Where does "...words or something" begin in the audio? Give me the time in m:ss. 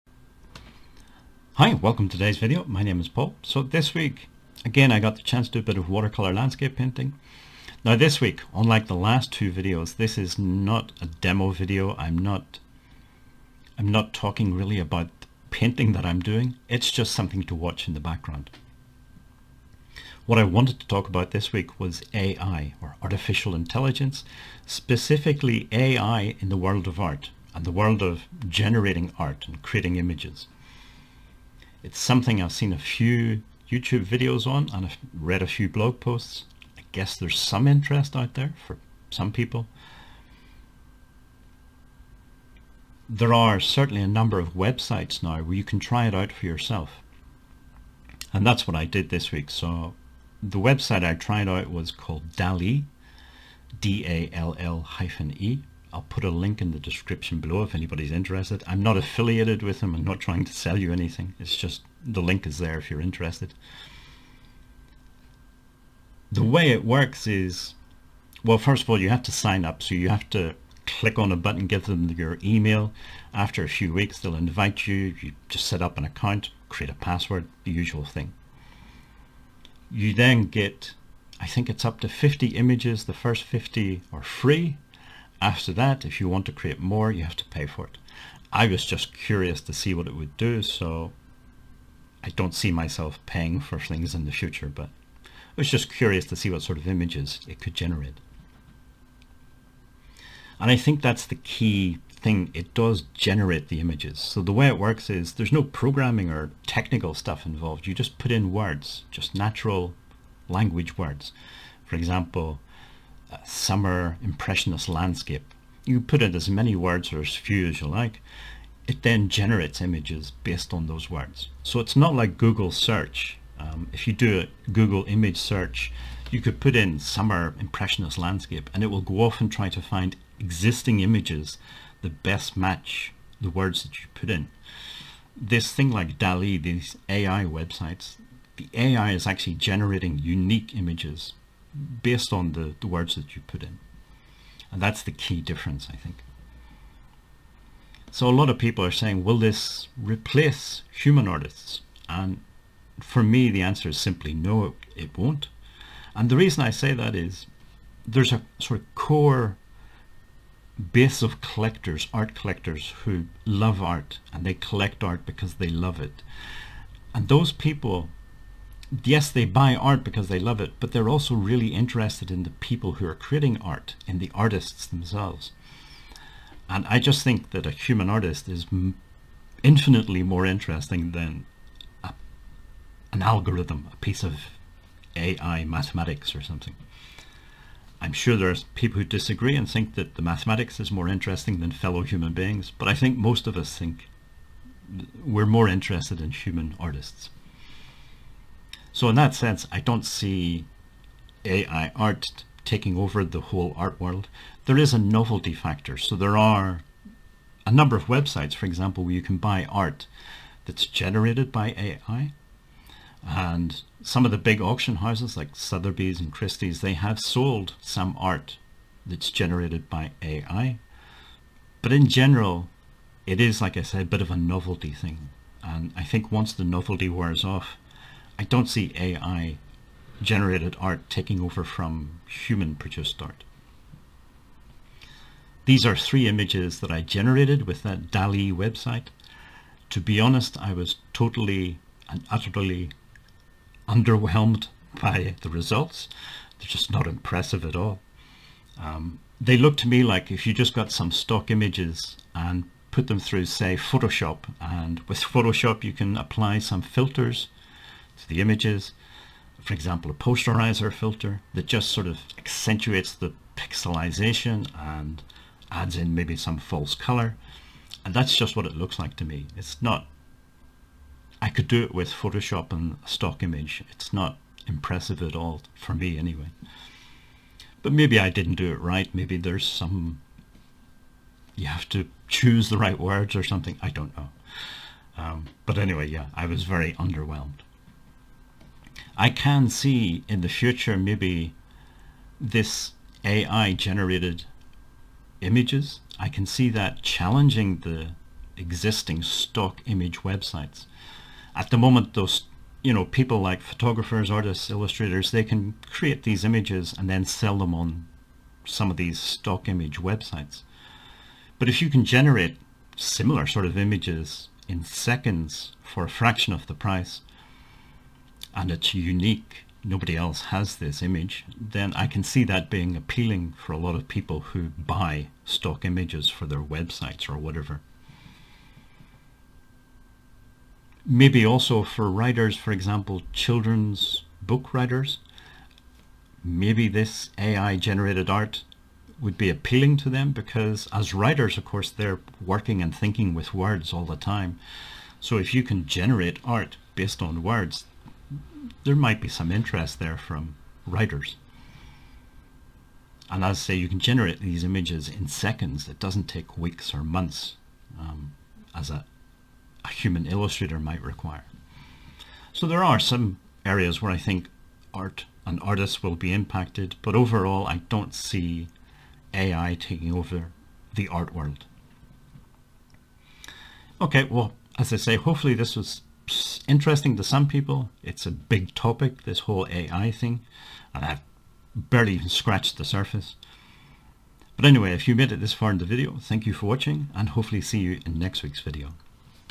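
4:42.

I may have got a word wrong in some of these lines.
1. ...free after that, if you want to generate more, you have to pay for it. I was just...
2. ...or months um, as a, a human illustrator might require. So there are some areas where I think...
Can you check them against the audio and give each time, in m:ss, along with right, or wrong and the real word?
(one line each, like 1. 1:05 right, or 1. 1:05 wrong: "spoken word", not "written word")
1. 1:24 wrong: "create", not "generate"
2. 5:56 right.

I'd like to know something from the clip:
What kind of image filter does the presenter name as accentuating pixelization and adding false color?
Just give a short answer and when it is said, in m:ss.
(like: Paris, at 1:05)
posterizer filter, at 4:20.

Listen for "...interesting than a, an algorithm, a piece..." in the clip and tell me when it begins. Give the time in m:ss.
3:00.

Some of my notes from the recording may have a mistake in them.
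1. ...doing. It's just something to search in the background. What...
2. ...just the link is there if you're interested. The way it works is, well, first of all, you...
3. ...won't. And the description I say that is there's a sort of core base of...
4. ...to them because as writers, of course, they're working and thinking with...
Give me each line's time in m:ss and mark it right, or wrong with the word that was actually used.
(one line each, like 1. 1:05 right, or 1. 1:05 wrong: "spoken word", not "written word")
1. 0:16 wrong: "watch", not "search"
2. 1:01 right
3. 2:35 wrong: "reason", not "description"
4. 5:39 right.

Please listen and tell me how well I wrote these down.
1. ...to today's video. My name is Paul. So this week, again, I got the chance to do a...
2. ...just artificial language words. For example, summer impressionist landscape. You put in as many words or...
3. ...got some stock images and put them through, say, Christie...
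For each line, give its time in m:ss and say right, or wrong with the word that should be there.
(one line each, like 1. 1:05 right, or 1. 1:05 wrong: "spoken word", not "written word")
1. 0:02 right
2. 1:49 wrong: "natural", not "artificial"
3. 4:10 wrong: "Photoshop", not "Christie".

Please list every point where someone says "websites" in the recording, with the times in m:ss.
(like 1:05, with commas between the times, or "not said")
0:44, 0:50, 2:17, 3:28, 3:58, 5:00, 5:09, 5:26.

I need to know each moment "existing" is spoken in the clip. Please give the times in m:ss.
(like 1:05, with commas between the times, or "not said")
2:10, 4:58.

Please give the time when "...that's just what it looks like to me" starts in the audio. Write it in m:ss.
4:28.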